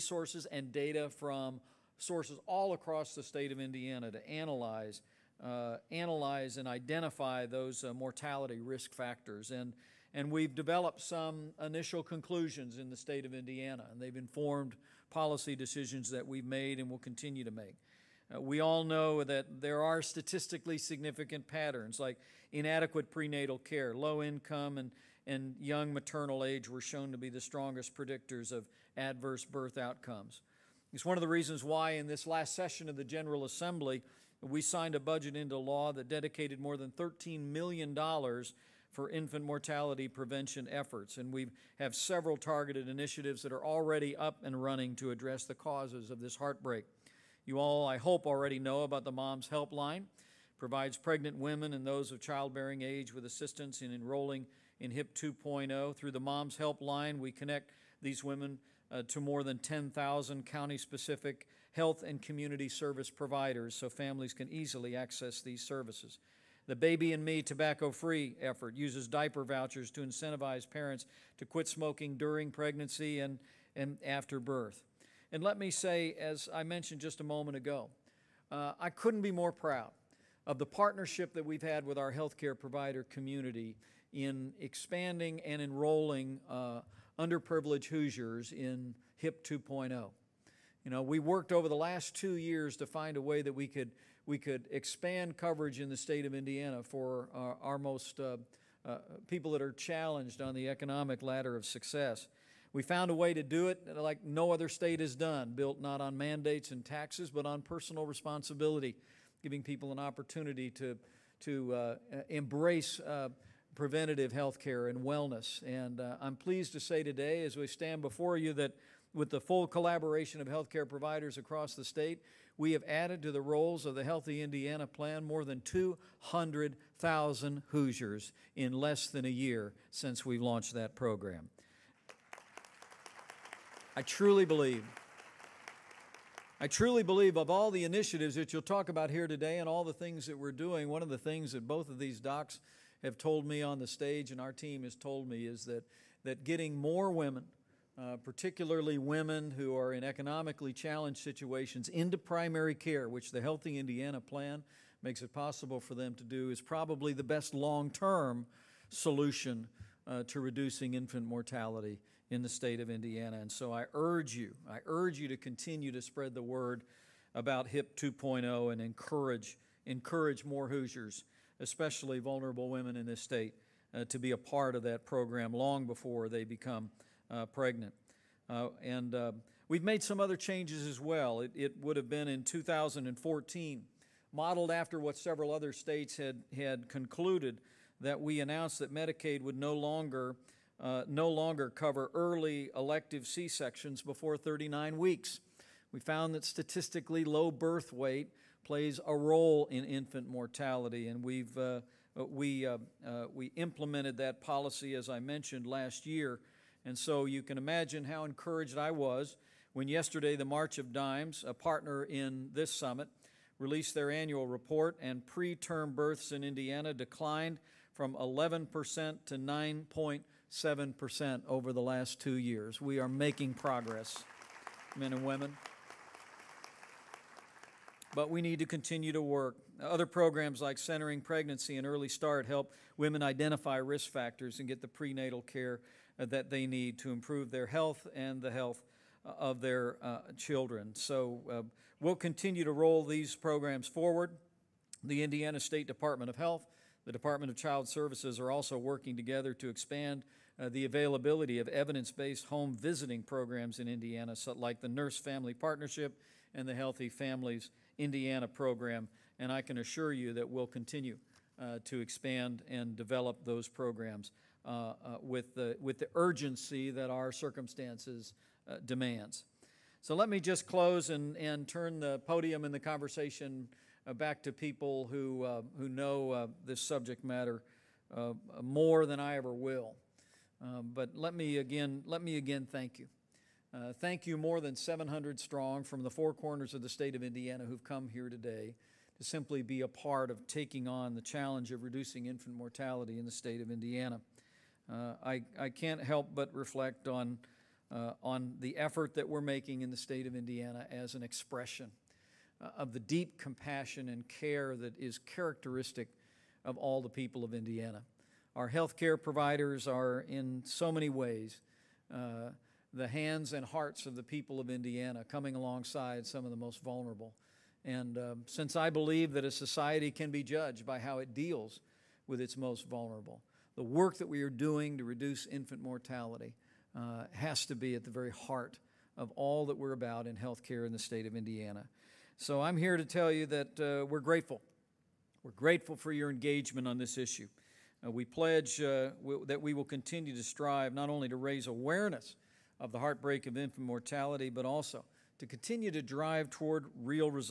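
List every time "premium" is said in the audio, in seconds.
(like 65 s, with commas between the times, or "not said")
not said.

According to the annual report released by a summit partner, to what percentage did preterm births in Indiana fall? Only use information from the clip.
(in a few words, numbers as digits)
9.7%.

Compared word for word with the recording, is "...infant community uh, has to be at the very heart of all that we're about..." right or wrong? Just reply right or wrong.
wrong.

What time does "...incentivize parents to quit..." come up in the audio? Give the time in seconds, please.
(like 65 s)
70 s.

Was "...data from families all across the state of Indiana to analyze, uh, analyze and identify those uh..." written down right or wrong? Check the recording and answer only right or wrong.
wrong.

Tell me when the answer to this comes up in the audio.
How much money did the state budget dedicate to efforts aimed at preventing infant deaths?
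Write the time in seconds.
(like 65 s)
36 s.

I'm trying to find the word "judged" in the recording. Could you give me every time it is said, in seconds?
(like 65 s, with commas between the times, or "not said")
320 s.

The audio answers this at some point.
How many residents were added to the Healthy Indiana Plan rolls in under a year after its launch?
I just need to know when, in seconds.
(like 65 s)
125 s.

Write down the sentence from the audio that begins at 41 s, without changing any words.
And we have several targeted initiatives that are already up and running to address the causes of this heartbreak.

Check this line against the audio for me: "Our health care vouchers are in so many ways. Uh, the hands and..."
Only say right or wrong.
wrong.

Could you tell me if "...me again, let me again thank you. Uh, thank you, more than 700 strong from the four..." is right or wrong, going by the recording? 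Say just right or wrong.
right.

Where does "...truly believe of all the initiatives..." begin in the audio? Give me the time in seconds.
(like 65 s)
136 s.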